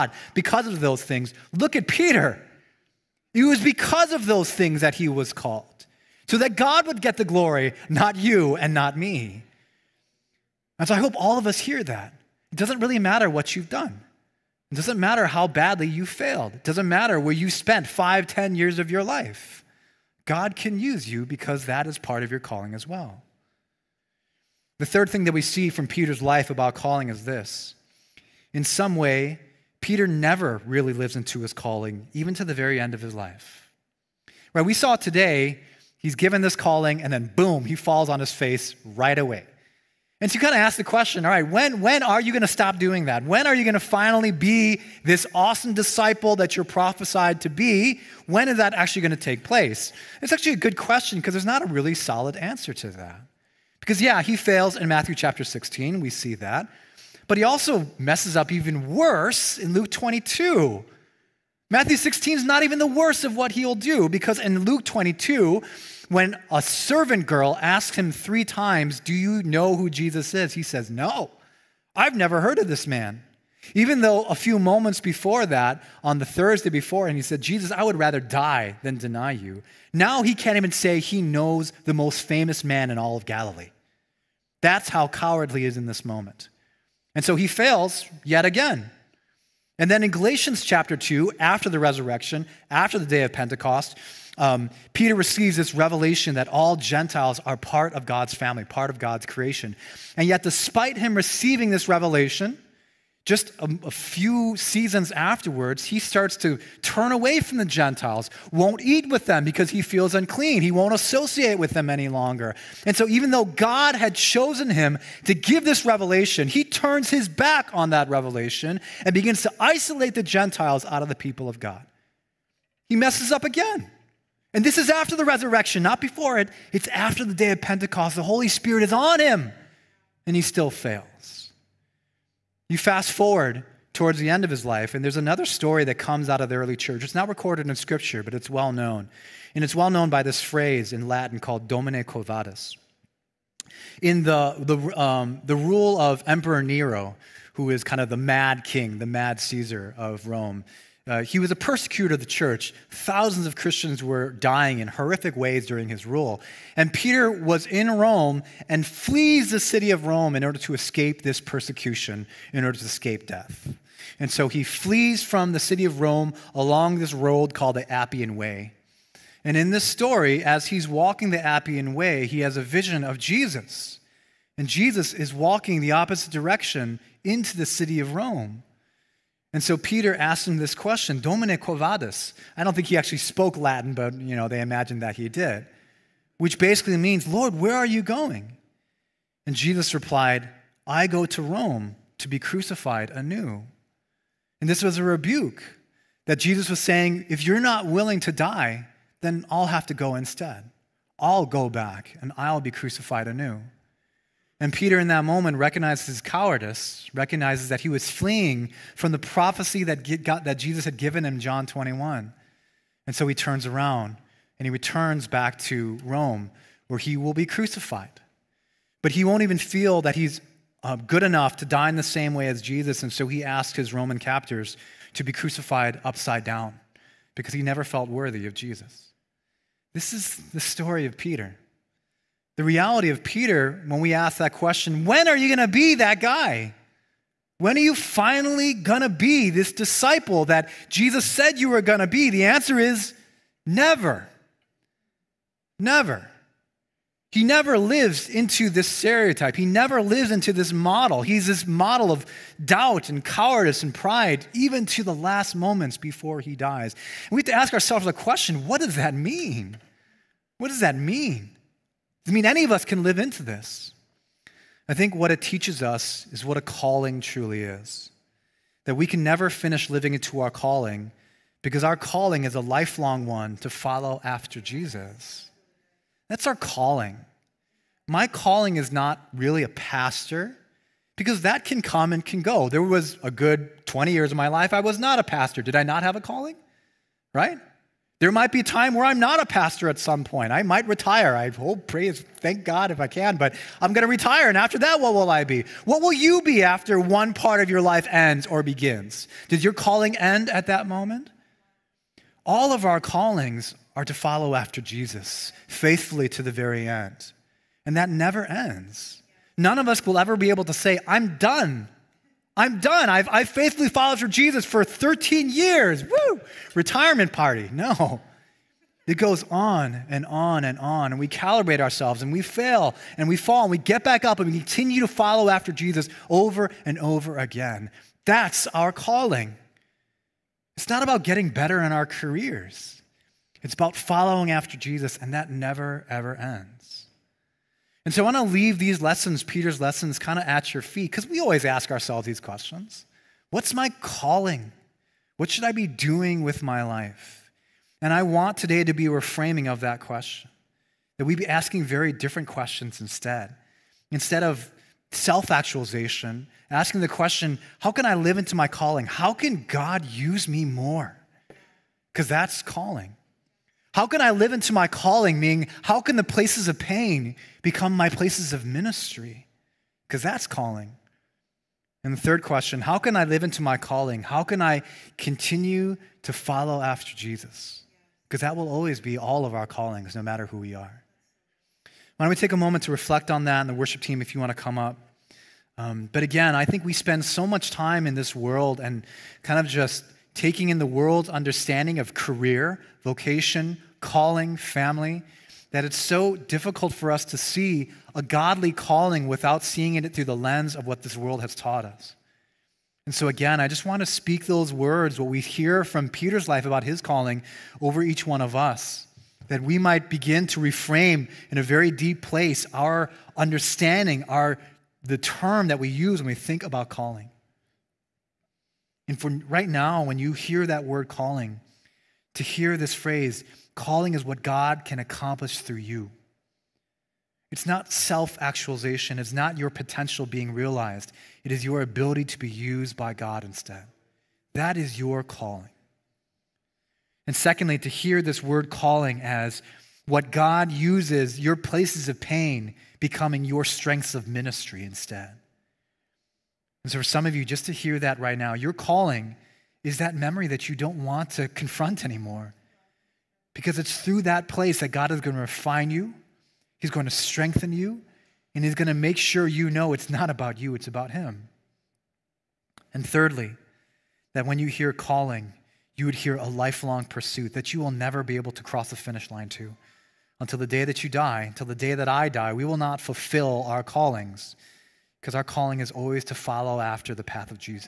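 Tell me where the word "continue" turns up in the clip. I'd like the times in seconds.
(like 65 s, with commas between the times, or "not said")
324 s, 375 s.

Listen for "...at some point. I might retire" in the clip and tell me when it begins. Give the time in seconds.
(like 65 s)
289 s.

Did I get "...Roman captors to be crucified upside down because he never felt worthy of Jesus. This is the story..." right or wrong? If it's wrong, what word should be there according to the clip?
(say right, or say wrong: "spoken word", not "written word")
right.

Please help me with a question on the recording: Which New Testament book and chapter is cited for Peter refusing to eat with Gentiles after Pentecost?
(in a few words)
Galatians chapter 2.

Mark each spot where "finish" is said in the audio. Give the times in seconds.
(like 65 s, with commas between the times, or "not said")
269 s, 468 s.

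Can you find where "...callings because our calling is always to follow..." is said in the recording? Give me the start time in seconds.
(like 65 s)
473 s.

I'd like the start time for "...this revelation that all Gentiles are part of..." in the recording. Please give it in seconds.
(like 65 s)
95 s.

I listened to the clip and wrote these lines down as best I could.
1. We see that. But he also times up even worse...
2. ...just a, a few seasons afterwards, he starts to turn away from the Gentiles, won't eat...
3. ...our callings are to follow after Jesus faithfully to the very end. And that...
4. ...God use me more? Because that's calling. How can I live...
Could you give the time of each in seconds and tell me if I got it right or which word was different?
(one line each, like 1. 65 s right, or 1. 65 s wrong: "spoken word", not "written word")
1. 56 s wrong: "messes", not "times"
2. 103 s right
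3. 302 s right
4. 359 s right.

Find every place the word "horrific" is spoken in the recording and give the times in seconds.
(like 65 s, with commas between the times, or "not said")
154 s.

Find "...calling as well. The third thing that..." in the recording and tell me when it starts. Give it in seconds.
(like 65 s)
22 s.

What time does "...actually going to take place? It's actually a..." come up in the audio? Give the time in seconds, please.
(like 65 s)
48 s.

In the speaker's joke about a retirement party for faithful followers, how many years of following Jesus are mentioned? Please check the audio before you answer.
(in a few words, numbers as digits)
13.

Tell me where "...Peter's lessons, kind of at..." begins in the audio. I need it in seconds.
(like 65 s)
339 s.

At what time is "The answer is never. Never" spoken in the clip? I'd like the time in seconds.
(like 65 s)
242 s.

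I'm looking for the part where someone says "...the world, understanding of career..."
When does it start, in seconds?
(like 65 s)
390 s.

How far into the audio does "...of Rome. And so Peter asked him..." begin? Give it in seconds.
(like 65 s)
177 s.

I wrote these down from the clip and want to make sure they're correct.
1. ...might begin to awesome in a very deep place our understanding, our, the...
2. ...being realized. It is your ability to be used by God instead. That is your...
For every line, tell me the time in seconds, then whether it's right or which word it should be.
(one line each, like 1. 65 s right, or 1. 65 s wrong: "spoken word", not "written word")
1. 409 s wrong: "reframe", not "awesome"
2. 430 s right.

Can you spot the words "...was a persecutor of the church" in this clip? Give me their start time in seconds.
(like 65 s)
151 s.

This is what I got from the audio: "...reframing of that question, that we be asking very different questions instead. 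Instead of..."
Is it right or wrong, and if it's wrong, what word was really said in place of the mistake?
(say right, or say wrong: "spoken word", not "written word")
right.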